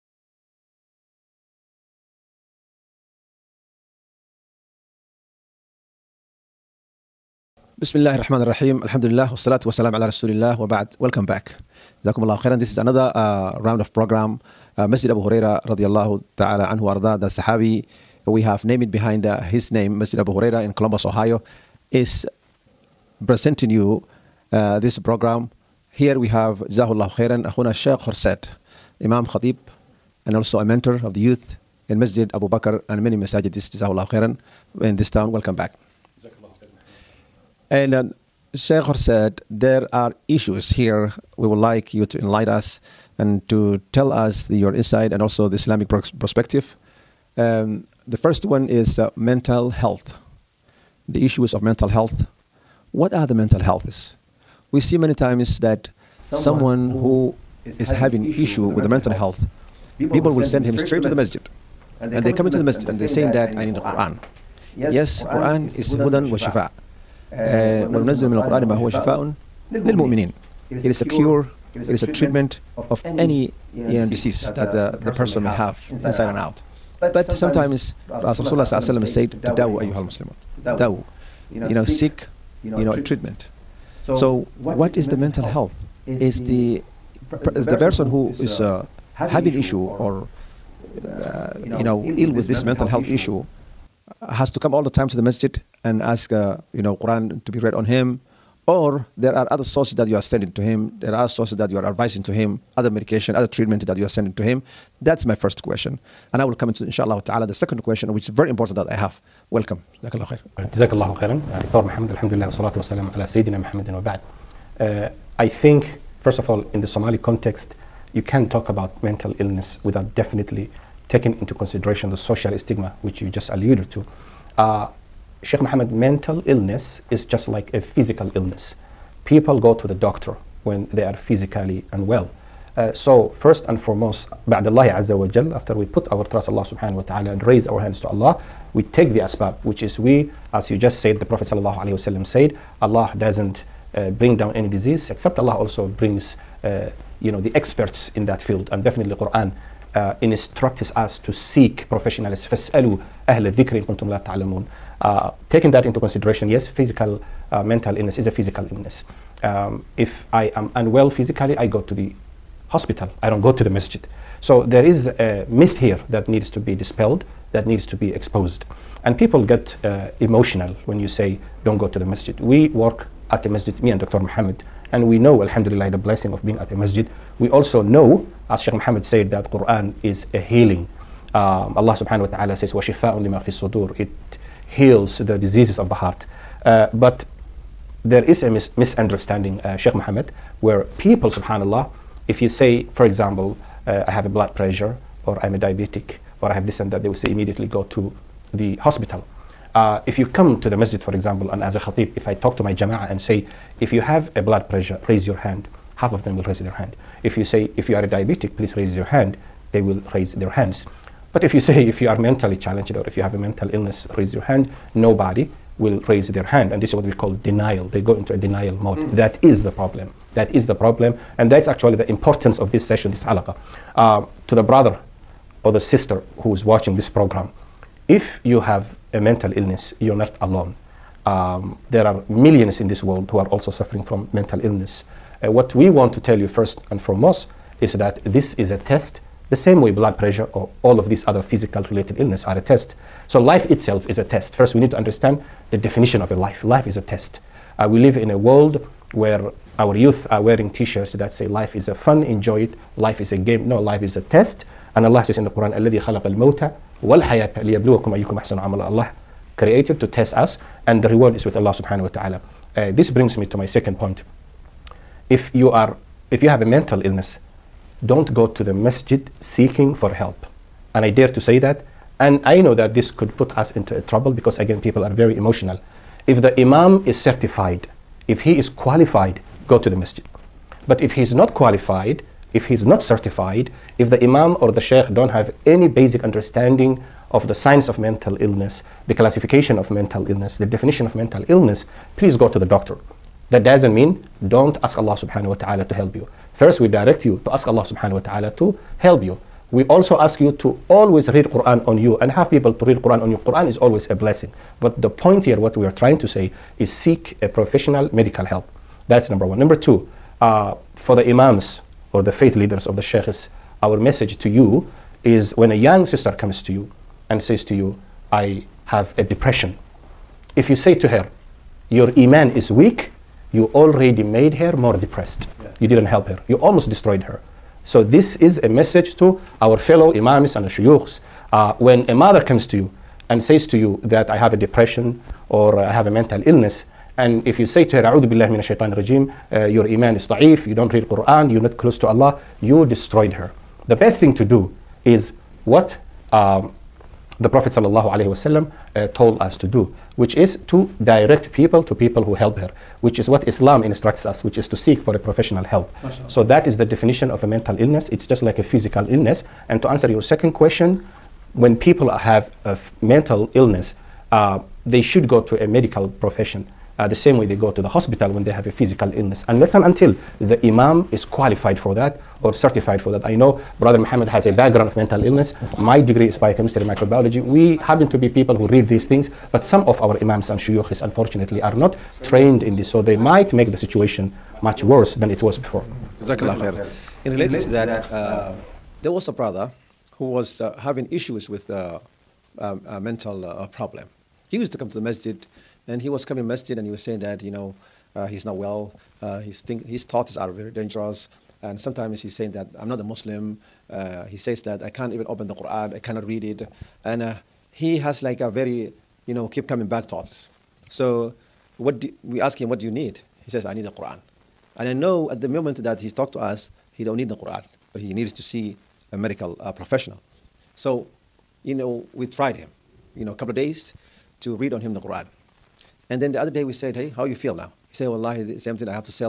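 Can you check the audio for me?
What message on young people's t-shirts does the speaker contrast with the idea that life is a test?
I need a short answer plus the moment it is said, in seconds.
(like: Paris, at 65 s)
Life is a game, at 252 s.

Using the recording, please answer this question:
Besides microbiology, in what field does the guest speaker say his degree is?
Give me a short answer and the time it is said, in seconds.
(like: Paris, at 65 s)
Biochemistry, at 376 s.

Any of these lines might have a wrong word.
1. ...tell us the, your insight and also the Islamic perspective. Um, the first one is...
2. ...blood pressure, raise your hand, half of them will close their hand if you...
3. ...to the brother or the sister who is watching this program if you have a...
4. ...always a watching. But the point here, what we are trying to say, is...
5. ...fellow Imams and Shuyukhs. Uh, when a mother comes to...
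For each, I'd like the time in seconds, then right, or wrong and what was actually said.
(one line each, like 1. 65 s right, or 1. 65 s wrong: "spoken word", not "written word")
1. 43 s right
2. 204 s wrong: "raise", not "close"
3. 224 s right
4. 303 s wrong: "blessing", not "watching"
5. 329 s right.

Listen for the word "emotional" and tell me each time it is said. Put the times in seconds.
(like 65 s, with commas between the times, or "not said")
170 s, 275 s.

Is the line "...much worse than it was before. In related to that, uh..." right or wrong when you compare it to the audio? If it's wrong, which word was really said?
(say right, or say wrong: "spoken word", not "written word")
right.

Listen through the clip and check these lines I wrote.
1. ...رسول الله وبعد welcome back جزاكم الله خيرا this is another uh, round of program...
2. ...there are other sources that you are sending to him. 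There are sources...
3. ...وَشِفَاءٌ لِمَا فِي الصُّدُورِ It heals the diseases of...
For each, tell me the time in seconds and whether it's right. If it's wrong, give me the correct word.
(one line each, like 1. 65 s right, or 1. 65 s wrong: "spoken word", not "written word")
1. 10 s right
2. 99 s right
3. 182 s right.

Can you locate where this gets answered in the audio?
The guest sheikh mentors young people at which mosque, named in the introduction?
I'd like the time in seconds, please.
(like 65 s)
31 s.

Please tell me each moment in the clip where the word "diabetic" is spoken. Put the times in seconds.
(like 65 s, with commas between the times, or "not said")
195 s, 208 s.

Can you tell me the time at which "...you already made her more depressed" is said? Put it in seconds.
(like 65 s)
323 s.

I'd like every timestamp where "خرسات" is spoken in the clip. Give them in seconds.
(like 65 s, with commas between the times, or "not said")
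28 s.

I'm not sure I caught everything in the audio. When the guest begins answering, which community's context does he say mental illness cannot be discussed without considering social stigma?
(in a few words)
Somali.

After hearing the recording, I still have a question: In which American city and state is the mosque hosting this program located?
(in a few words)
Columbus Ohio.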